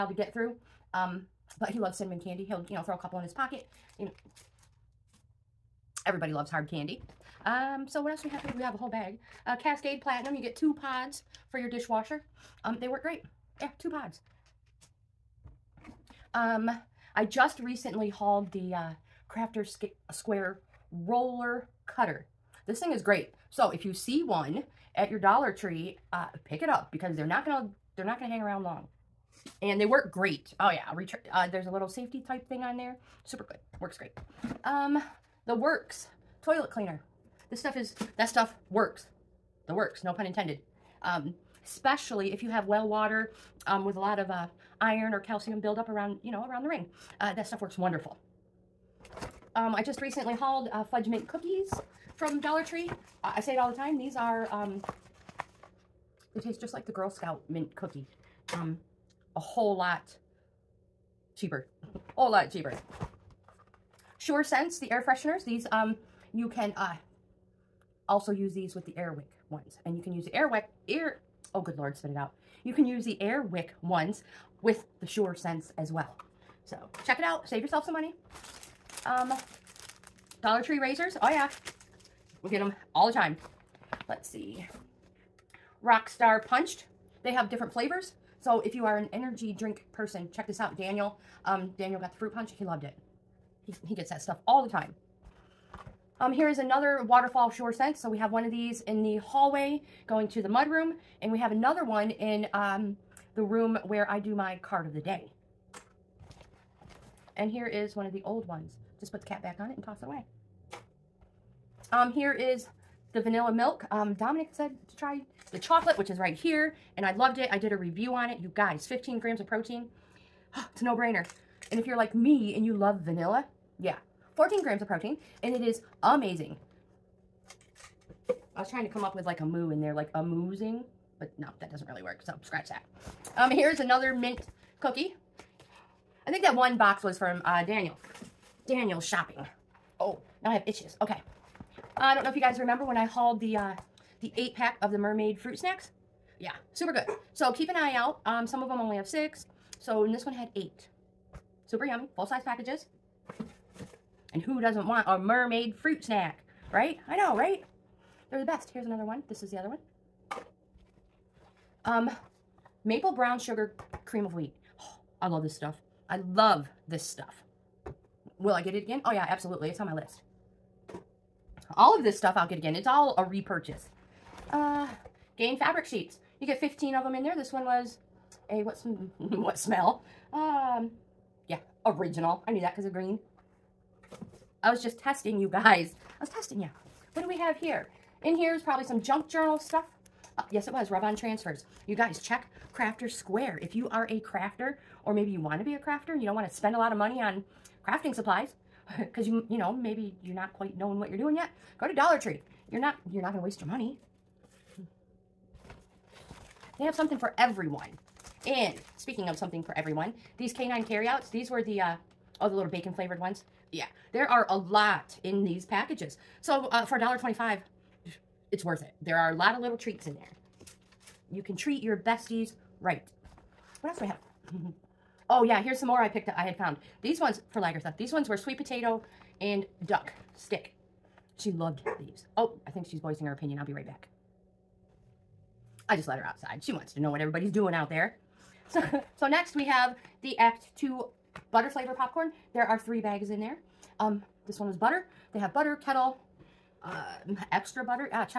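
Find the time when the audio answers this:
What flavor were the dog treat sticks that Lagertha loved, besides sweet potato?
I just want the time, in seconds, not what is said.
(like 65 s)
229 s.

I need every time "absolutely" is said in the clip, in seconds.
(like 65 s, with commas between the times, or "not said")
169 s.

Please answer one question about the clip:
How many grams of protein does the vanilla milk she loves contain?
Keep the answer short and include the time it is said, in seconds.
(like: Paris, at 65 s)
14, at 124 s.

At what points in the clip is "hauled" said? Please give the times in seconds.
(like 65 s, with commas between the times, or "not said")
18 s, 50 s, 143 s.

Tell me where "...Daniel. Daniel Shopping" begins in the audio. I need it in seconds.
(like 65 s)
137 s.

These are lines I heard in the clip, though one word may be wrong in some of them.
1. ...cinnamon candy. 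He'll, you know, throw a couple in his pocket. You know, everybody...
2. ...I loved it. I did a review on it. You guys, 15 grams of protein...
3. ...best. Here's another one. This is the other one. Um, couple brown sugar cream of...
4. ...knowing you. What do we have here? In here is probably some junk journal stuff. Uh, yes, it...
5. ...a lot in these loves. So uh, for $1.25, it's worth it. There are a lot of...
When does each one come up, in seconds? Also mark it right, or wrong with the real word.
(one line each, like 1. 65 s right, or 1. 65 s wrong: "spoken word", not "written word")
1. 1 s right
2. 117 s right
3. 158 s wrong: "maple", not "couple"
4. 186 s wrong: "testing", not "knowing"
5. 214 s wrong: "packages", not "loves".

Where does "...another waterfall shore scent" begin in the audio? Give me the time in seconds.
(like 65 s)
96 s.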